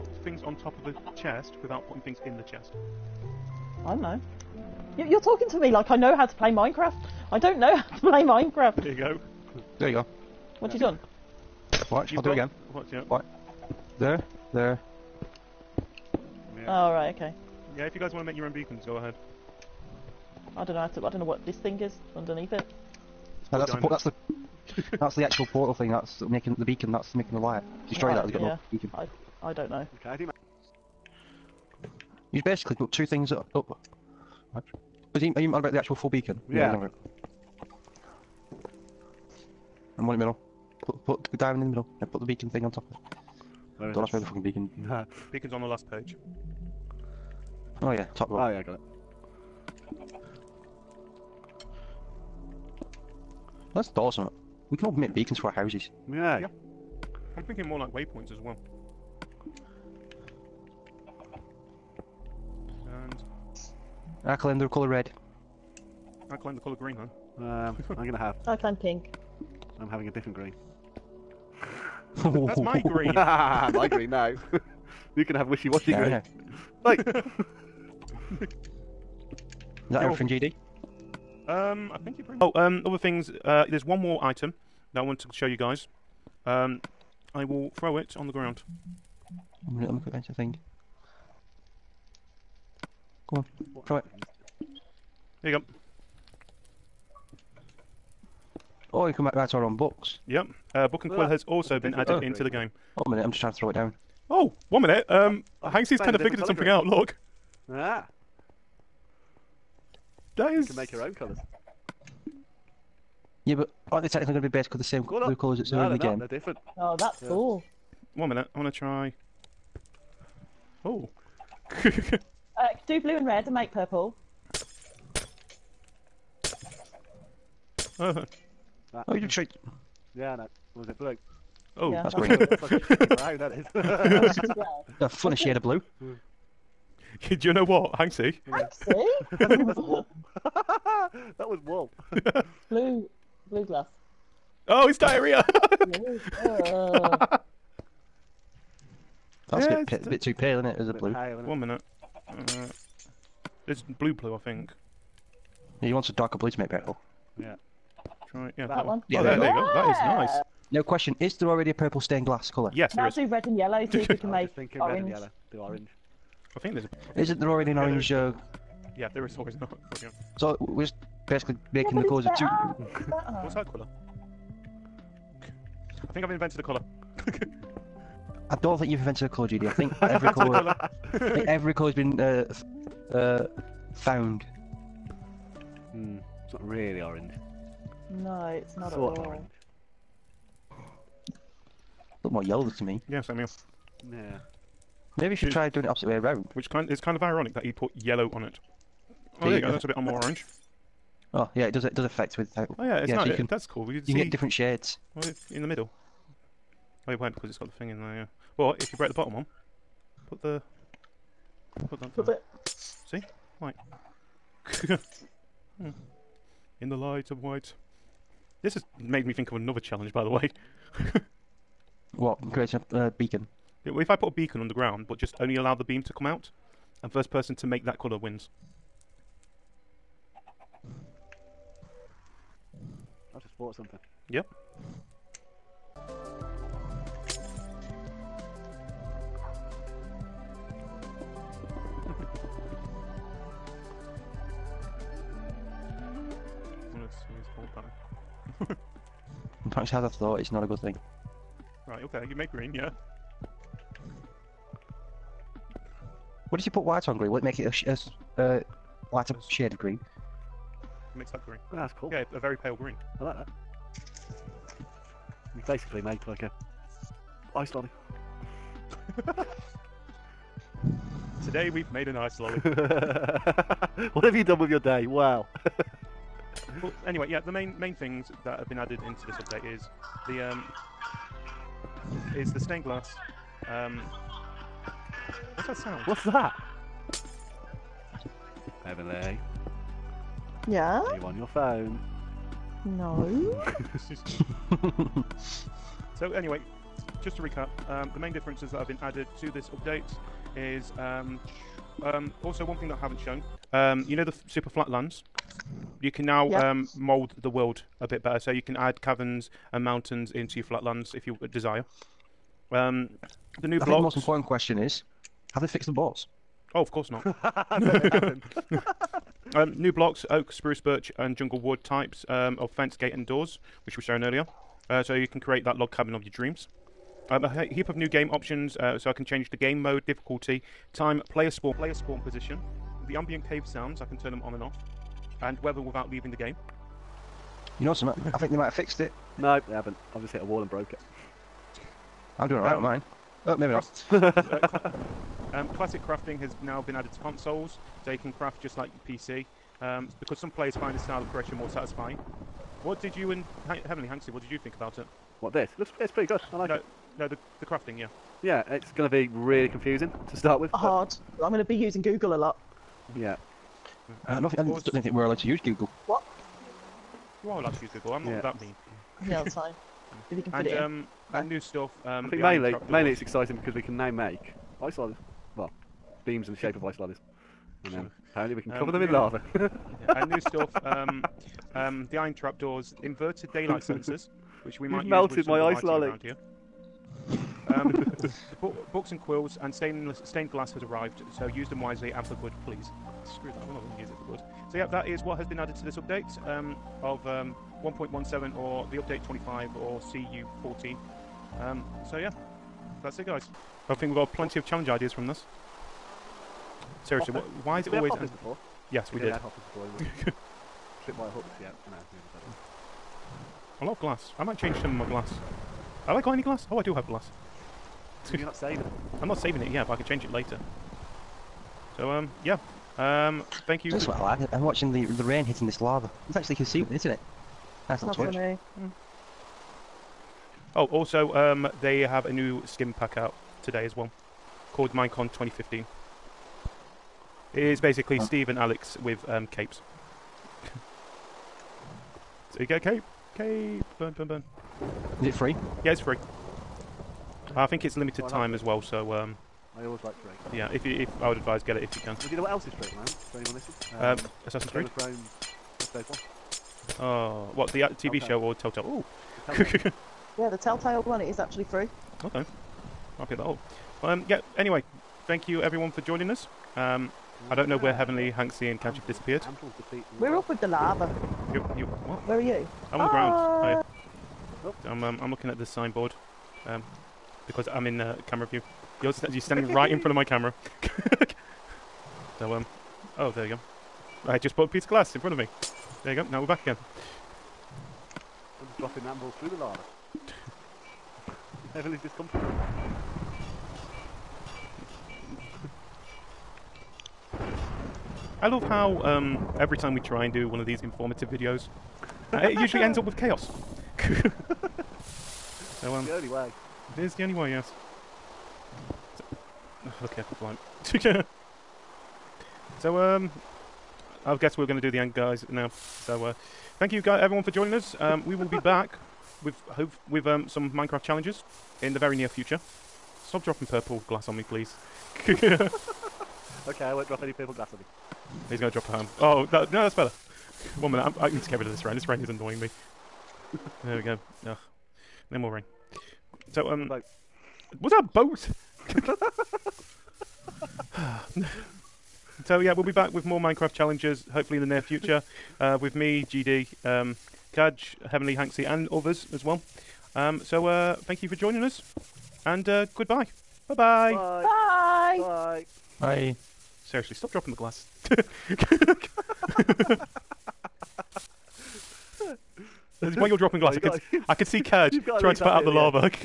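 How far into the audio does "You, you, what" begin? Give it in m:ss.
7:51.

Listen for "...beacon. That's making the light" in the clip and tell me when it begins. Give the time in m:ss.
0:26.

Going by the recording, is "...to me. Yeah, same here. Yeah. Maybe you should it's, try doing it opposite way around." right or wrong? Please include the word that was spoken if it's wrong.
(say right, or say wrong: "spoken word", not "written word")
right.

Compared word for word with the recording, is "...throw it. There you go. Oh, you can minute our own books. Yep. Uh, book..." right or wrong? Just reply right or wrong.
wrong.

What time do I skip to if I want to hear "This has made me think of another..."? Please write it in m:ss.
3:38.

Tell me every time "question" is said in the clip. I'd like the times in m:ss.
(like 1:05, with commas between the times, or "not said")
2:40, 5:14.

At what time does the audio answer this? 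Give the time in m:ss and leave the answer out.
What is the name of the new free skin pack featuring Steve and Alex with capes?
7:14.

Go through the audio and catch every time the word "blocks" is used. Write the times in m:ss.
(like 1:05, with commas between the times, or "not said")
5:13, 5:19.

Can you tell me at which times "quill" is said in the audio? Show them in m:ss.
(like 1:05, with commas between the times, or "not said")
1:41, 6:29.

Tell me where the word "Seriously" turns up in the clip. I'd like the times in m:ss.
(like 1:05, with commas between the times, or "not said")
6:47, 9:16.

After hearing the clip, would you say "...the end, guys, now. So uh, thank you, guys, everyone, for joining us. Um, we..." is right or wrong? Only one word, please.
right.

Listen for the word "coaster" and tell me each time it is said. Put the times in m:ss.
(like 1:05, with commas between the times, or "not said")
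not said.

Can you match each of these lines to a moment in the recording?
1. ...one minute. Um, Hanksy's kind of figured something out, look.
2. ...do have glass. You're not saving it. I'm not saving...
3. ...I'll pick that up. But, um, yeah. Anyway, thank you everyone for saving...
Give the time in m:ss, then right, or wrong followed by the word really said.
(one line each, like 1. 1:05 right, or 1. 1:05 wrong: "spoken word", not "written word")
1. 1:44 right
2. 6:56 right
3. 7:43 wrong: "joining", not "saving".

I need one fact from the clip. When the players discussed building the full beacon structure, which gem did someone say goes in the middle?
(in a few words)
Diamond.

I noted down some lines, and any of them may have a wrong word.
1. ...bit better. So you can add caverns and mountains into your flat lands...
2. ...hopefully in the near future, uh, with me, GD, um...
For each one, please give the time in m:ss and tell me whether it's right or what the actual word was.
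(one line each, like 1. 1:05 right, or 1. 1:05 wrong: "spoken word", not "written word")
1. 5:08 right
2. 9:04 right.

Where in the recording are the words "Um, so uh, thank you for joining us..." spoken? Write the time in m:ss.
9:10.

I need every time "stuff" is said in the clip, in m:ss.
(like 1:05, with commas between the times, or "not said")
6:11, 6:20.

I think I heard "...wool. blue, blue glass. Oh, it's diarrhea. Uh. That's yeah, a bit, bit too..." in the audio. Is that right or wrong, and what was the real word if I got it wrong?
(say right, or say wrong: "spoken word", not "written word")
right.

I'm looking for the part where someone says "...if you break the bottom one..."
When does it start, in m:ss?
3:28.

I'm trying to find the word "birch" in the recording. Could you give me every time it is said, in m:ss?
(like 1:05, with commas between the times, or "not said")
5:20.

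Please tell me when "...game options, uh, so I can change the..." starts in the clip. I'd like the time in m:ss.
5:28.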